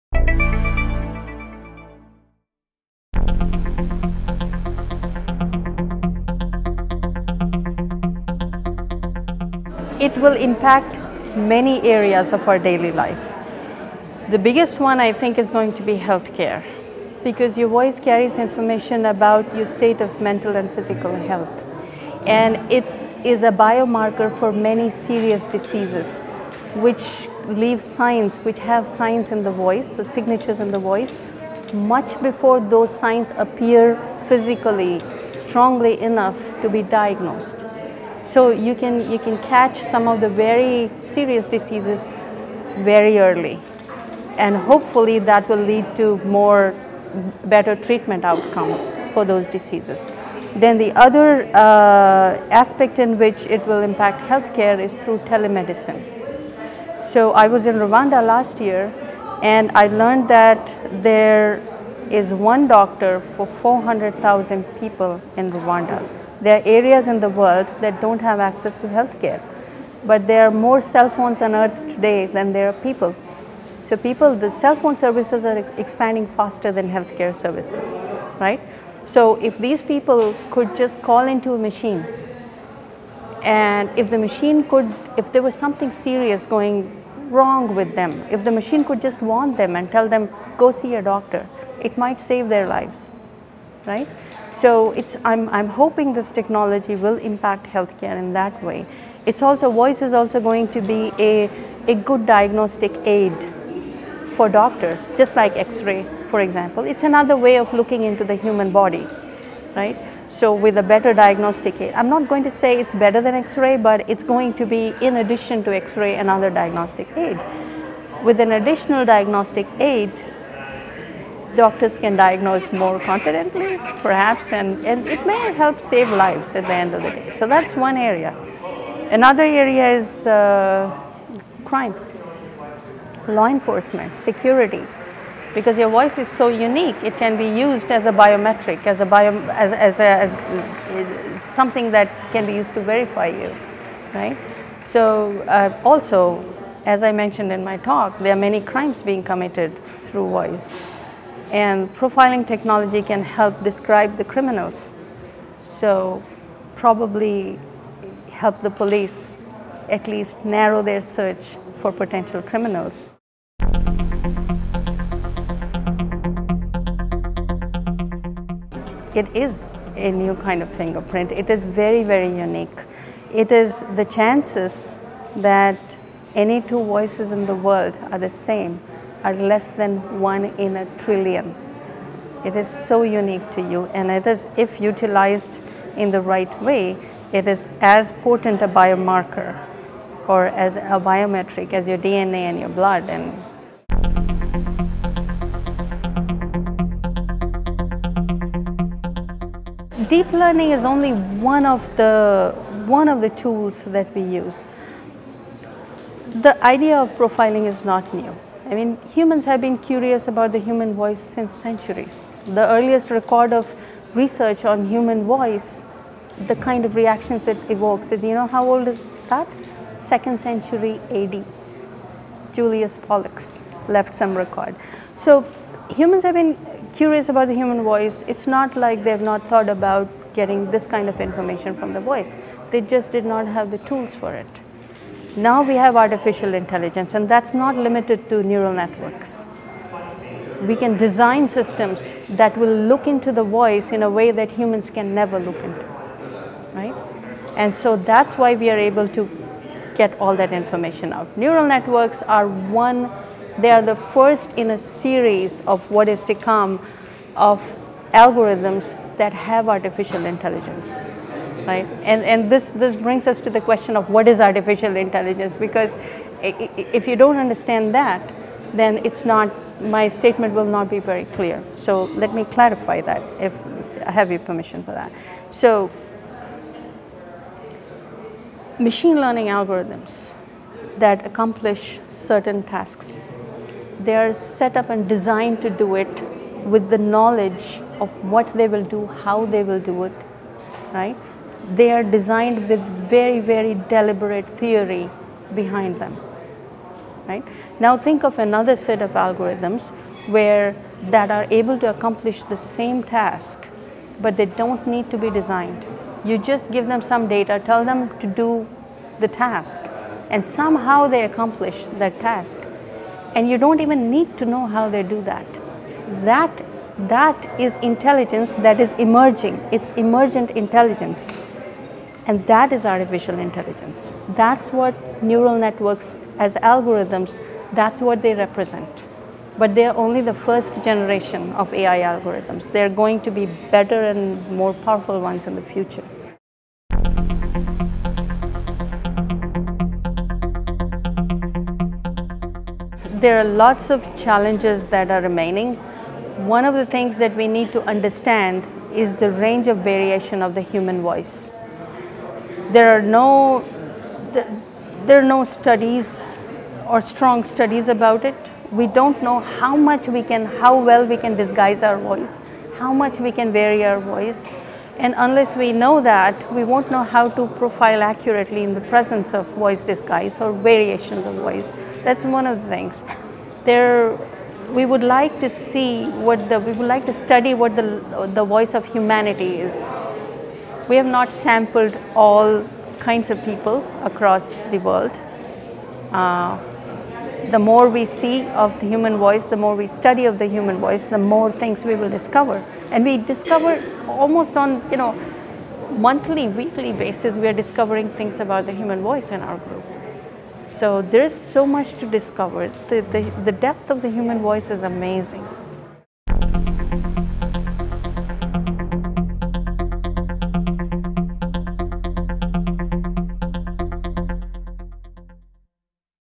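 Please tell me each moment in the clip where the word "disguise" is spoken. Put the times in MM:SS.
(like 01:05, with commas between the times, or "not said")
06:01, 06:09.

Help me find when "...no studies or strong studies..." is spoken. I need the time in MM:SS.
05:55.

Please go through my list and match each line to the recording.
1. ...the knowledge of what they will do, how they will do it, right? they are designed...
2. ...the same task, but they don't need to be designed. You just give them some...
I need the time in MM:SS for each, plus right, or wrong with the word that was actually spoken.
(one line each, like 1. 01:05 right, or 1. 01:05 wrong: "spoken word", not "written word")
1. 04:46 right
2. 05:02 right.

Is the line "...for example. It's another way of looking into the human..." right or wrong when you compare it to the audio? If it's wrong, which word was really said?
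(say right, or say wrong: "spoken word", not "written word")
right.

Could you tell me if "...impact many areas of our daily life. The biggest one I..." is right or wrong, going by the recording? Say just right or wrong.
right.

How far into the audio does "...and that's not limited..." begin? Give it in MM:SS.
03:57.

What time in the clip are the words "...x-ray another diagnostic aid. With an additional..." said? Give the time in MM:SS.
01:55.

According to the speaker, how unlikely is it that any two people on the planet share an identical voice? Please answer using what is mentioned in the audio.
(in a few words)
a trillion.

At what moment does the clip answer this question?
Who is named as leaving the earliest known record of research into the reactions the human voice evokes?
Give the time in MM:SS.
03:42.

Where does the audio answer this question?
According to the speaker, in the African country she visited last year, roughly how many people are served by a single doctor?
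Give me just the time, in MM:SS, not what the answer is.
01:03.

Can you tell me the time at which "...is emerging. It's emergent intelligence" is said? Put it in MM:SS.
05:18.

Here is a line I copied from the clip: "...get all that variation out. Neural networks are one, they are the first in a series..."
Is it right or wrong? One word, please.
wrong.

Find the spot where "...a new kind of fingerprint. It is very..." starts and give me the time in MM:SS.
02:49.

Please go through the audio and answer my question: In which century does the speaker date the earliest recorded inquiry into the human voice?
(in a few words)
Second century AD.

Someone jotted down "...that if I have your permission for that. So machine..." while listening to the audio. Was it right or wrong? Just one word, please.
right.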